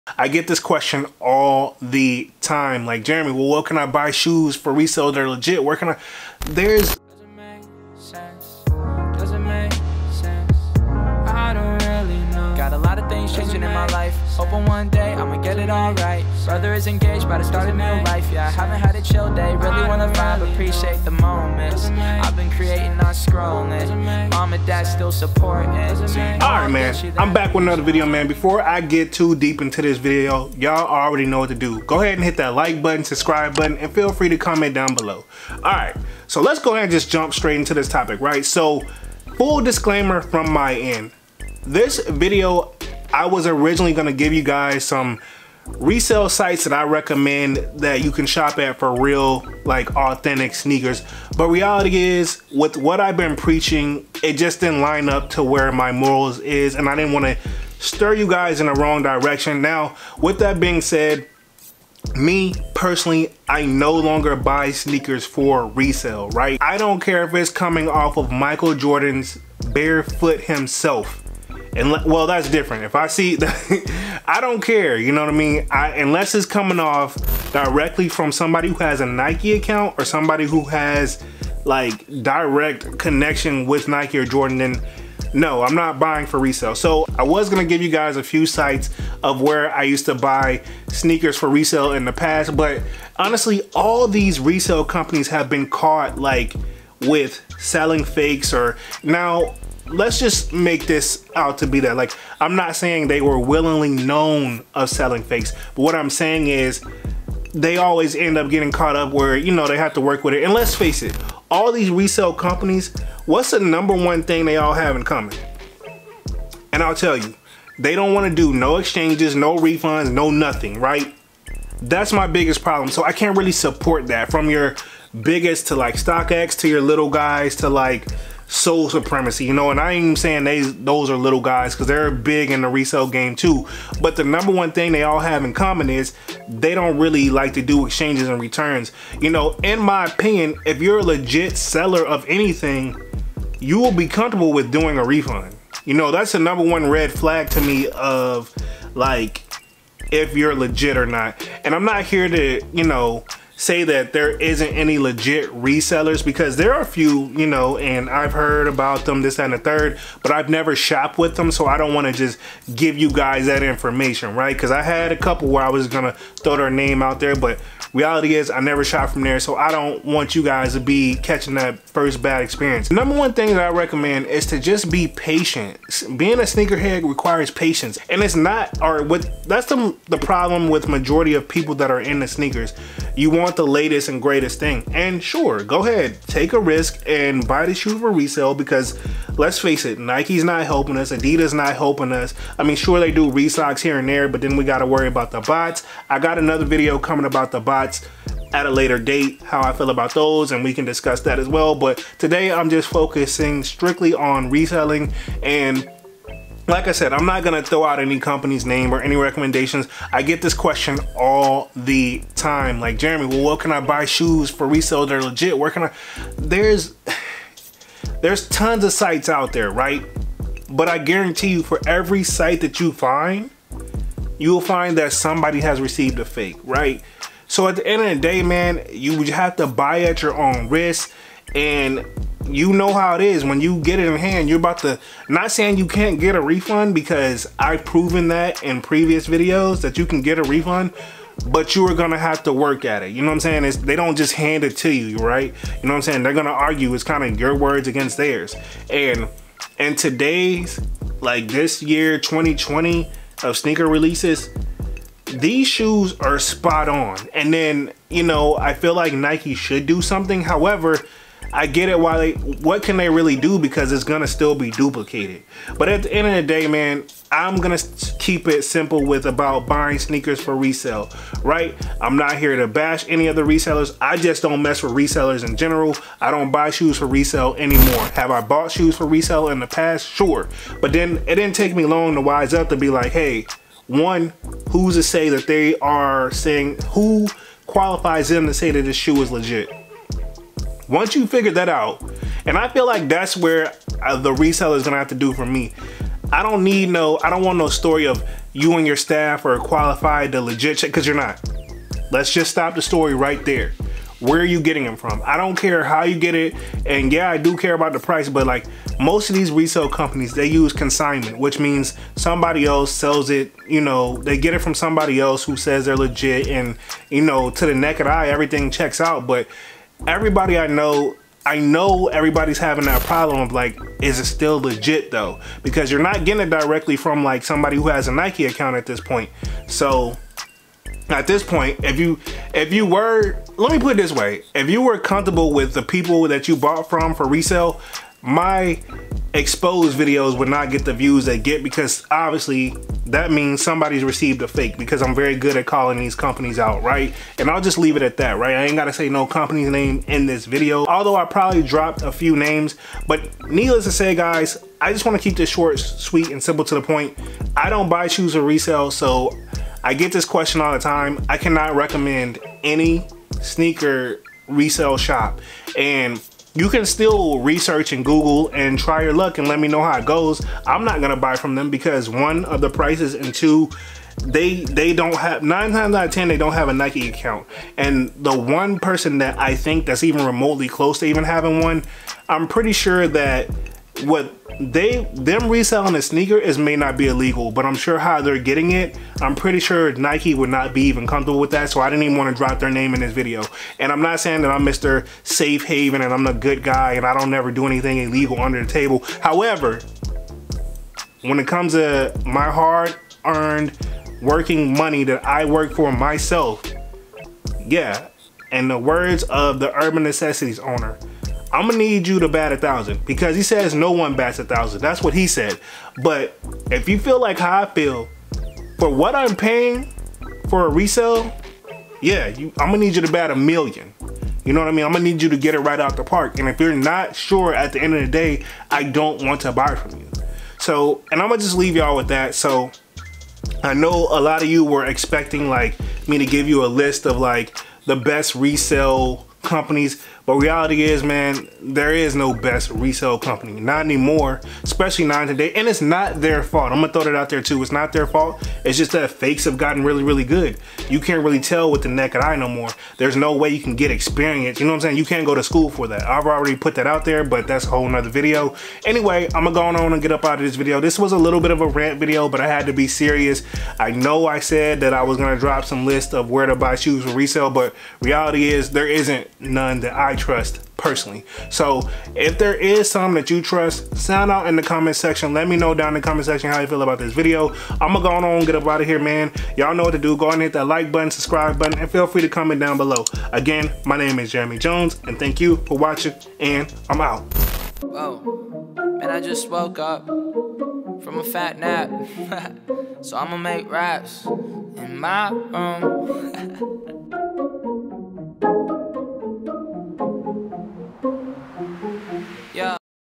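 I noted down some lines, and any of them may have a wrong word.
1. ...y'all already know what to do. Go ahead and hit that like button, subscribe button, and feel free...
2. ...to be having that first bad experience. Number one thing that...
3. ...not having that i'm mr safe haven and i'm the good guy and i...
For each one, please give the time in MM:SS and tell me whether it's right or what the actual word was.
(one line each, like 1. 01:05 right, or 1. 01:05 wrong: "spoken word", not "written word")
1. 00:30 right
2. 02:50 wrong: "catching", not "having"
3. 06:34 wrong: "saying", not "having".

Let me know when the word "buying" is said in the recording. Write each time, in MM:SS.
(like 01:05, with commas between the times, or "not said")
01:25, 04:29.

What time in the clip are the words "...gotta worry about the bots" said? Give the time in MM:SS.
03:14.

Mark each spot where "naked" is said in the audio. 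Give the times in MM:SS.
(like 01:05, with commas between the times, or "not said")
05:17, 07:31.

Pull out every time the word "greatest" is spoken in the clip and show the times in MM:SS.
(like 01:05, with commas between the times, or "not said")
03:04.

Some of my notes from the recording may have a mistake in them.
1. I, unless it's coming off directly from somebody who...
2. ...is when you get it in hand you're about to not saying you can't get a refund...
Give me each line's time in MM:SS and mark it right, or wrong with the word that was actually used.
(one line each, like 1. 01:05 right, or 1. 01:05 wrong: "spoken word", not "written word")
1. 01:15 right
2. 03:53 right.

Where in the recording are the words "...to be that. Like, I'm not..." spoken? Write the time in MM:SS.
01:41.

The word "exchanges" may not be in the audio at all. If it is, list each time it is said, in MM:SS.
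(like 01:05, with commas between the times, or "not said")
01:58, 02:17.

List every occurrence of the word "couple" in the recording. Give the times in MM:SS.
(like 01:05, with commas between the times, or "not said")
02:45.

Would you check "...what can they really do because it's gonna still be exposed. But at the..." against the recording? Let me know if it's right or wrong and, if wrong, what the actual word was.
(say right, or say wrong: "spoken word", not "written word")
wrong: "duplicated", not "exposed".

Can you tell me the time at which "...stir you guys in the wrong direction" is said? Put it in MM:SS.
00:57.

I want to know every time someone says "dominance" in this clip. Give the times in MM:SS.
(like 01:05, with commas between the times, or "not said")
not said.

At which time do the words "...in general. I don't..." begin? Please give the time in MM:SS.
04:35.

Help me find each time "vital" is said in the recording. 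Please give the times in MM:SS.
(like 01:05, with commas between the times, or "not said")
not said.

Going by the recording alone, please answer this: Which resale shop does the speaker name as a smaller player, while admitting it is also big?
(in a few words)
Sole Supremacy.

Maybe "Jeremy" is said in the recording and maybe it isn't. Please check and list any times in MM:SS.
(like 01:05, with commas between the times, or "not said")
00:03, 03:32, 08:04.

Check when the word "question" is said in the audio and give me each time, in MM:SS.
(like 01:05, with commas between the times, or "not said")
00:00, 03:30, 06:00.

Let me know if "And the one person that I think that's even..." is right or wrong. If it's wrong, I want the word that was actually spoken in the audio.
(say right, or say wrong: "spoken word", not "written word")
right.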